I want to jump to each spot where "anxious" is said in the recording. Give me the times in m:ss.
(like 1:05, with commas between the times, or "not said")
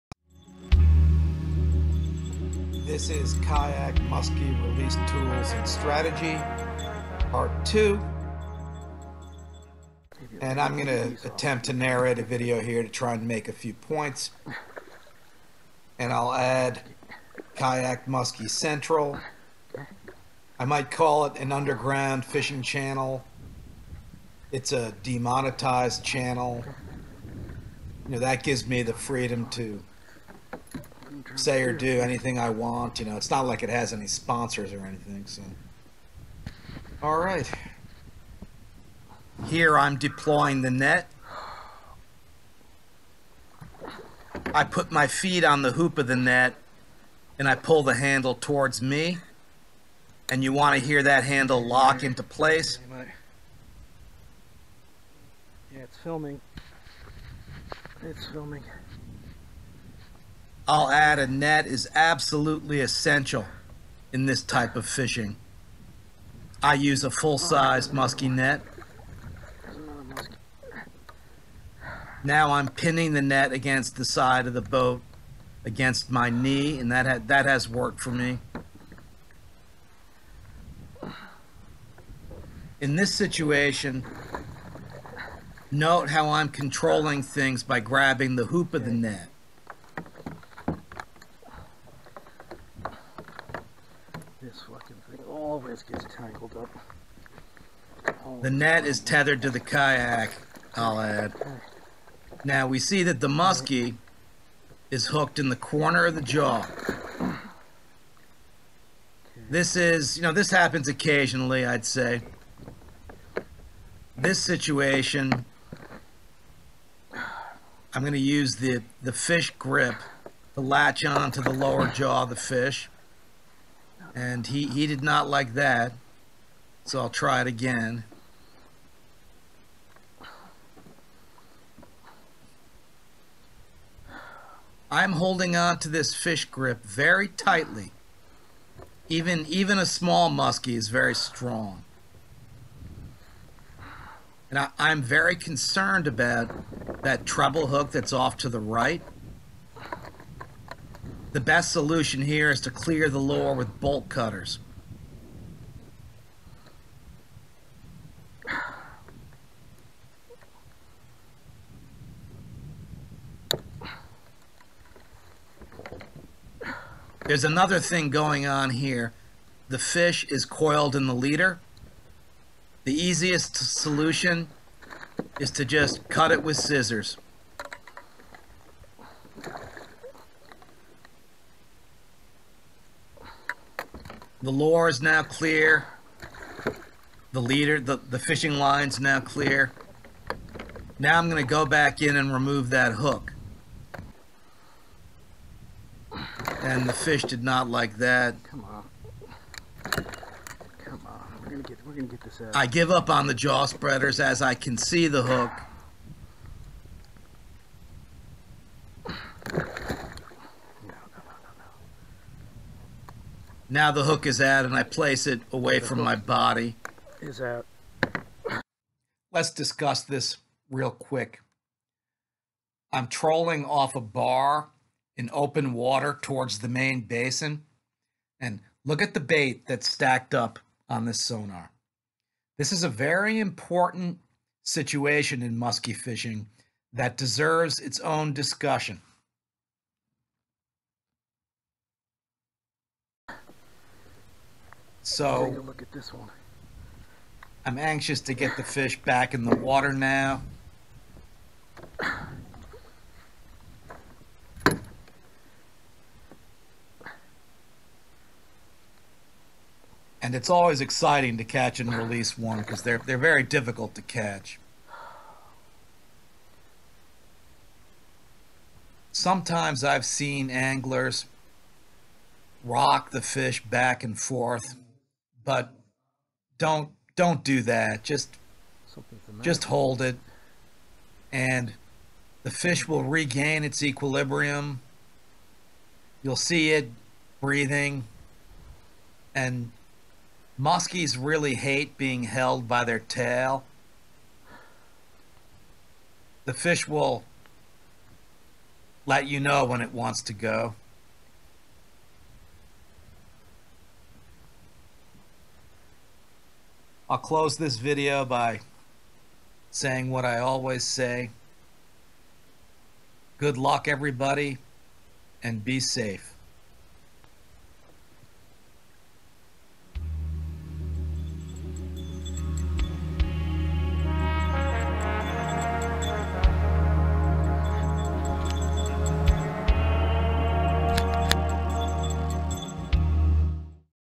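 4:07.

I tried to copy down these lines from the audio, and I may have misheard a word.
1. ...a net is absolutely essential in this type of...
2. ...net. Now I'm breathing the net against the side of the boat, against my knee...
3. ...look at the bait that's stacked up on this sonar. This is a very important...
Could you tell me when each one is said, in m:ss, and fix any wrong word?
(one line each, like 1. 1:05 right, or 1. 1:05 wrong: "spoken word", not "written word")
1. 1:01 right
2. 1:08 wrong: "pinning", not "breathing"
3. 3:48 right.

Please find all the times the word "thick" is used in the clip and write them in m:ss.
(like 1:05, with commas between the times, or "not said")
not said.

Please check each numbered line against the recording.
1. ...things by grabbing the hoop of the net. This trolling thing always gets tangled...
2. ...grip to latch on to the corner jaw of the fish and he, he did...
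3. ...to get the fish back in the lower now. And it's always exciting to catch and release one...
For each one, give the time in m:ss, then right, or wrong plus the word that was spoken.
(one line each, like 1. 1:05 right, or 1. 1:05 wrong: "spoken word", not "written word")
1. 1:27 wrong: "fucking", not "trolling"
2. 1:59 wrong: "lower", not "corner"
3. 4:08 wrong: "water", not "lower".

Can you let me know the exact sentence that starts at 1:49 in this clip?
This is, you know, this happens occasionally, I'd say.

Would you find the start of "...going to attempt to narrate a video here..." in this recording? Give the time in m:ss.
0:10.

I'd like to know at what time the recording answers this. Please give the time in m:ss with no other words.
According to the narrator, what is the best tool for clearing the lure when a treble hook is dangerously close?
2:33.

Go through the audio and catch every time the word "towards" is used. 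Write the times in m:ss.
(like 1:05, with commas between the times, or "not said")
0:48, 3:46.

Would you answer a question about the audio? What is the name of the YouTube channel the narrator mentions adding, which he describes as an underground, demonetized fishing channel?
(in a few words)
Kayak Musky Central.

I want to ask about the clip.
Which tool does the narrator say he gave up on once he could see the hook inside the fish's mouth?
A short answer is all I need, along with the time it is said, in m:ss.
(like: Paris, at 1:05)
jaw spreaders, at 3:23.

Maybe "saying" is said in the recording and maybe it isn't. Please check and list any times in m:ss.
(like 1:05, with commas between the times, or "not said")
5:09.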